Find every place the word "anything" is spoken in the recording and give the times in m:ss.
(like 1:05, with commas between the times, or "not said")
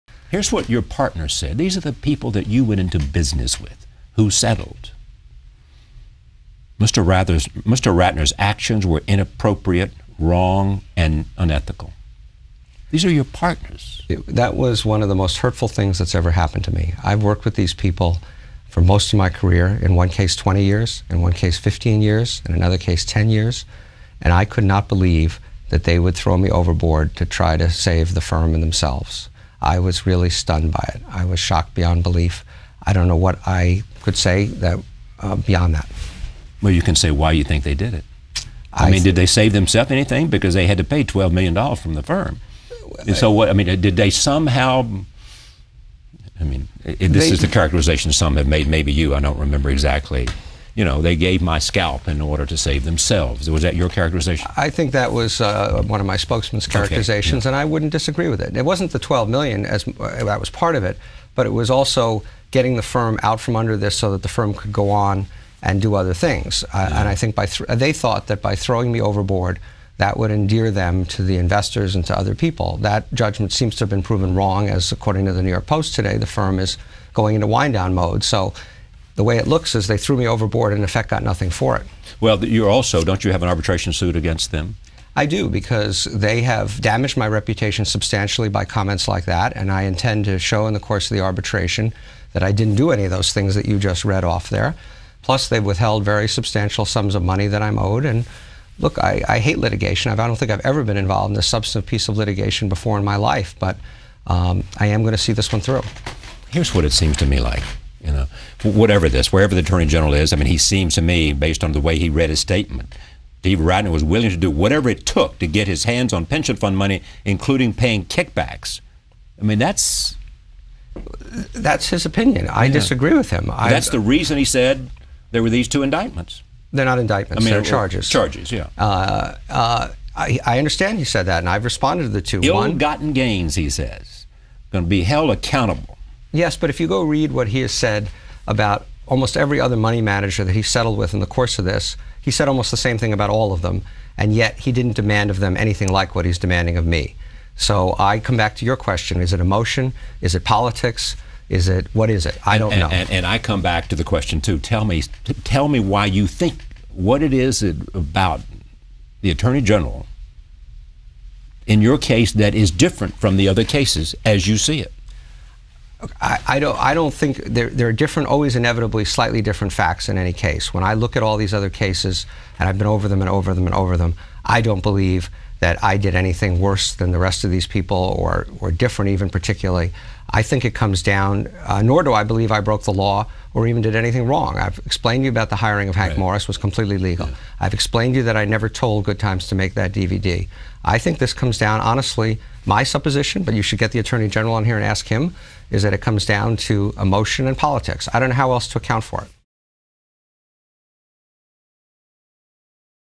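0:39, 2:25, 2:56, 3:03.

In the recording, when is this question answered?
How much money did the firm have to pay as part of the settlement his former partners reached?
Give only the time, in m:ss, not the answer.
0:41.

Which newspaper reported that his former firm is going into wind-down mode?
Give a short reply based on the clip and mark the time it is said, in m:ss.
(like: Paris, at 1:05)
New York Post, at 1:15.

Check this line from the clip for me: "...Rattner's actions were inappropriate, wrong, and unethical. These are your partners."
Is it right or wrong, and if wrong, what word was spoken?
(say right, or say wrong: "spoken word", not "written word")
right.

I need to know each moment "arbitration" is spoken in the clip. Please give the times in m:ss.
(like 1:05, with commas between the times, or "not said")
1:23, 1:31.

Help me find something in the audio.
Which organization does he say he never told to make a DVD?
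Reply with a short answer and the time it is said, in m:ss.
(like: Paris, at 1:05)
Good Times, at 3:09.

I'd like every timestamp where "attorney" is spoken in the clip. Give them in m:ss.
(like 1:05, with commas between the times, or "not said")
1:49, 2:39, 3:13.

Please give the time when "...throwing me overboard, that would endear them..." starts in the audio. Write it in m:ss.
1:08.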